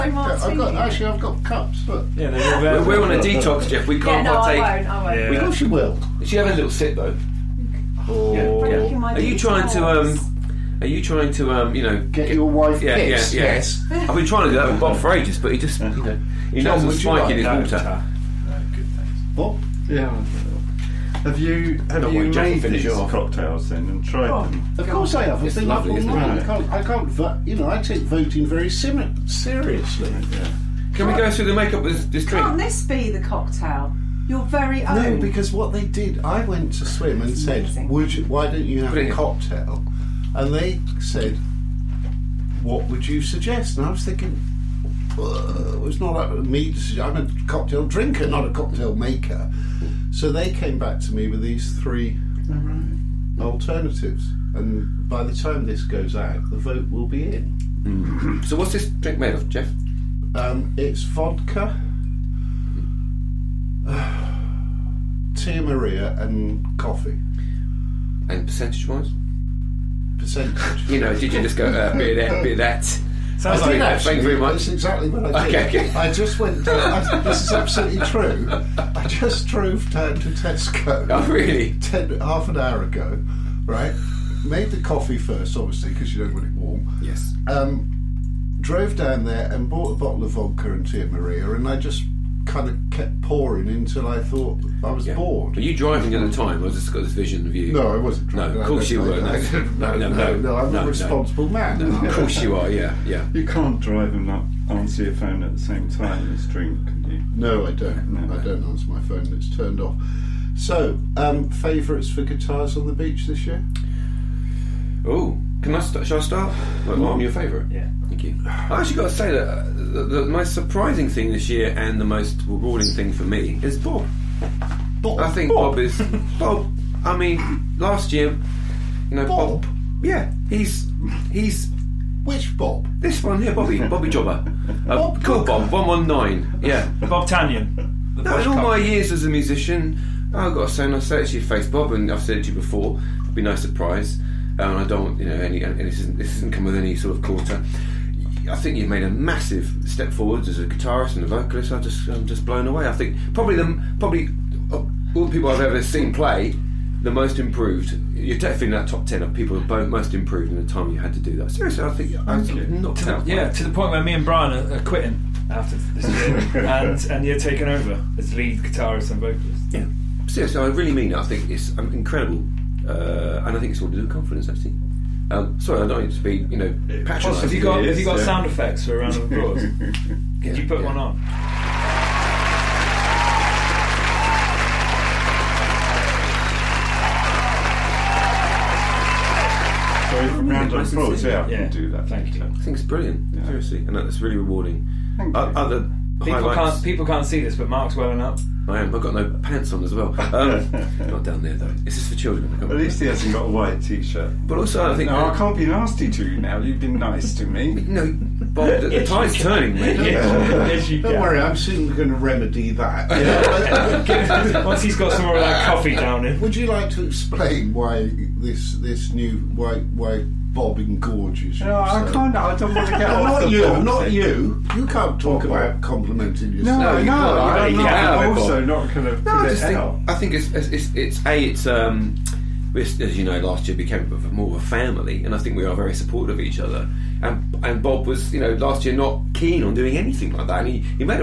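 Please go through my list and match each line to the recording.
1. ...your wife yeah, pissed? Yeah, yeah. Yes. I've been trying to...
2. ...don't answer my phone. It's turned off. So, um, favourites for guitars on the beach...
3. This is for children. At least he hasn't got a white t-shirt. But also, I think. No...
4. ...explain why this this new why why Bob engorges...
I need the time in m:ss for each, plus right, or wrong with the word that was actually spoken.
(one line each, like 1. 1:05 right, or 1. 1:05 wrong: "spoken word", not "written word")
1. 0:12 right
2. 1:48 right
3. 3:21 right
4. 3:37 right.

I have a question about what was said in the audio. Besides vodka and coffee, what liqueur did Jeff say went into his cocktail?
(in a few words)
Tia Maria.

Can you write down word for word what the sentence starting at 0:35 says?
No, because what they did, I went to swim and said, amazing.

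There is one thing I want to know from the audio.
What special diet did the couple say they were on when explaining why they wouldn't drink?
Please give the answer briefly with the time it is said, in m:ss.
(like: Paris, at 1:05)
a detox, at 0:03.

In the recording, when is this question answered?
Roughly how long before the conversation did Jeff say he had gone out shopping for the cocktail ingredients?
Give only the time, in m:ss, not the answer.
1:22.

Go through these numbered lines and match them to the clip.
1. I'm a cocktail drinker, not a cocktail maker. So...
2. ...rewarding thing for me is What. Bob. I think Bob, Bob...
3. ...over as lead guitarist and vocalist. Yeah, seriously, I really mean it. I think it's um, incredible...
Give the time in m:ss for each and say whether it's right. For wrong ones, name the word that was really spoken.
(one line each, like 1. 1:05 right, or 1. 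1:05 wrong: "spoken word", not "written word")
1. 0:47 right
2. 2:02 wrong: "Bob", not "What"
3. 2:47 right.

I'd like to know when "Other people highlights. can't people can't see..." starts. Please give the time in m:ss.
3:15.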